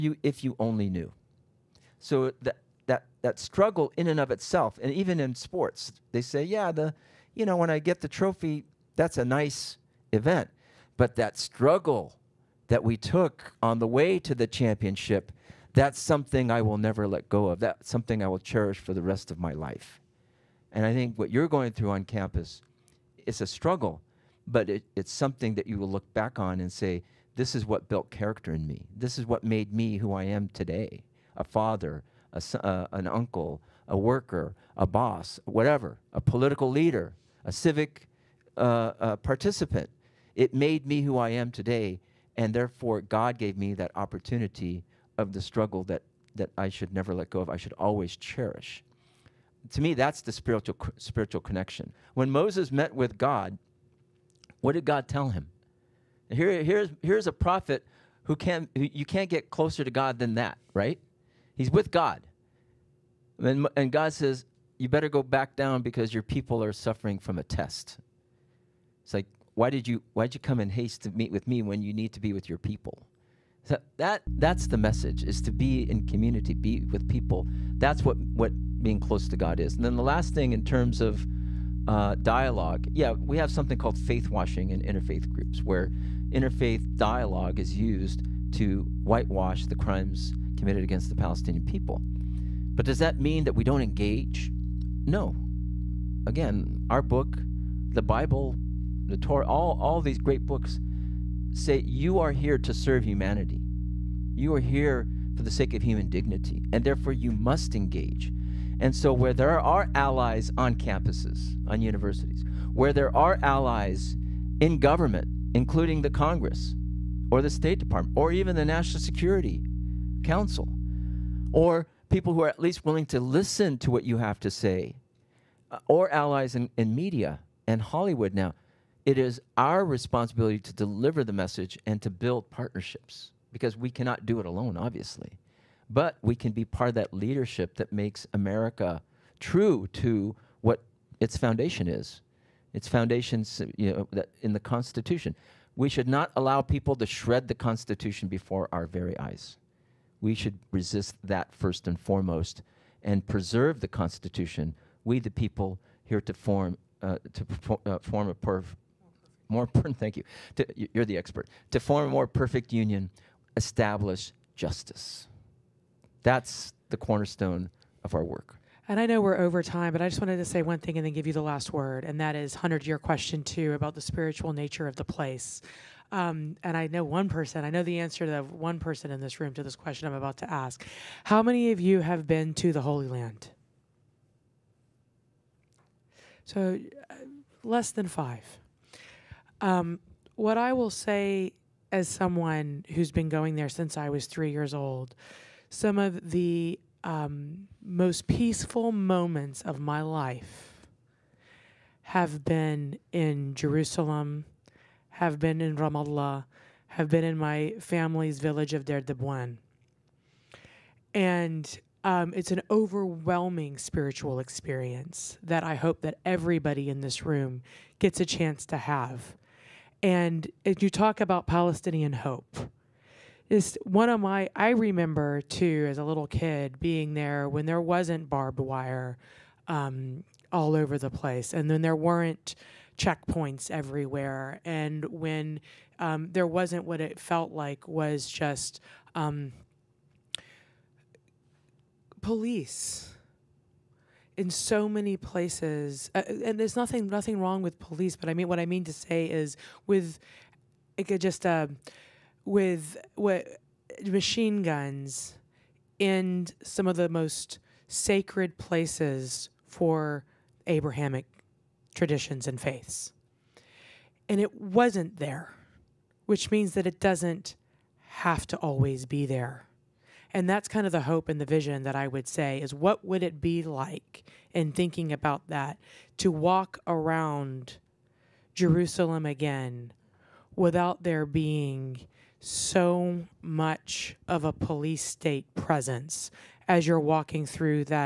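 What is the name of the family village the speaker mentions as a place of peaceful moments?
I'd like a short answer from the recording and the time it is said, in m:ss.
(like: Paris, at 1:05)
Derdabwan, at 3:28.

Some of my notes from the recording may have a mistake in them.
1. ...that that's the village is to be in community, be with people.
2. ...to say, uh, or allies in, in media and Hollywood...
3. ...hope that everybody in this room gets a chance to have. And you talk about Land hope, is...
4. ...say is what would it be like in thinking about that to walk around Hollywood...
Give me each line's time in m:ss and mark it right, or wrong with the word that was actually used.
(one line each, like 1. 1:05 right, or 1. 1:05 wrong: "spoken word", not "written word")
1. 1:13 wrong: "message", not "village"
2. 2:04 right
3. 3:35 wrong: "Palestinian", not "Land"
4. 4:32 wrong: "Jerusalem", not "Hollywood".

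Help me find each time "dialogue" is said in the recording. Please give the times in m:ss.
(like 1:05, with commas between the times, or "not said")
1:22, 1:26.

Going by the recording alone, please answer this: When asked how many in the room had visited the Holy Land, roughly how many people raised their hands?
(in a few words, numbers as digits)
less than 5.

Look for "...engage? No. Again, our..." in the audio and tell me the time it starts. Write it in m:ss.
1:33.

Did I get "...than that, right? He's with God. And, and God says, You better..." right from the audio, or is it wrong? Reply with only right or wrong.
right.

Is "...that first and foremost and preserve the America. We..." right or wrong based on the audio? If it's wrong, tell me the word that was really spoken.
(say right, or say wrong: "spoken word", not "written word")
wrong: "Constitution", not "America".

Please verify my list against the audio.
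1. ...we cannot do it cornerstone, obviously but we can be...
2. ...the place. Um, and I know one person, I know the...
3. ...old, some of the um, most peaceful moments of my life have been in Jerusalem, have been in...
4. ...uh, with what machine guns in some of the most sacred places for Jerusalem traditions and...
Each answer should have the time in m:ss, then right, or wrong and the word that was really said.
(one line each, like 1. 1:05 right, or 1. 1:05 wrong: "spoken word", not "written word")
1. 2:13 wrong: "alone", not "cornerstone"
2. 2:54 right
3. 3:14 right
4. 4:11 wrong: "Abrahamic", not "Jerusalem".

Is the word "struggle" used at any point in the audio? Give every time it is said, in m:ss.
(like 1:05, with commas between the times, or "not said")
0:03, 0:11, 0:23, 0:45.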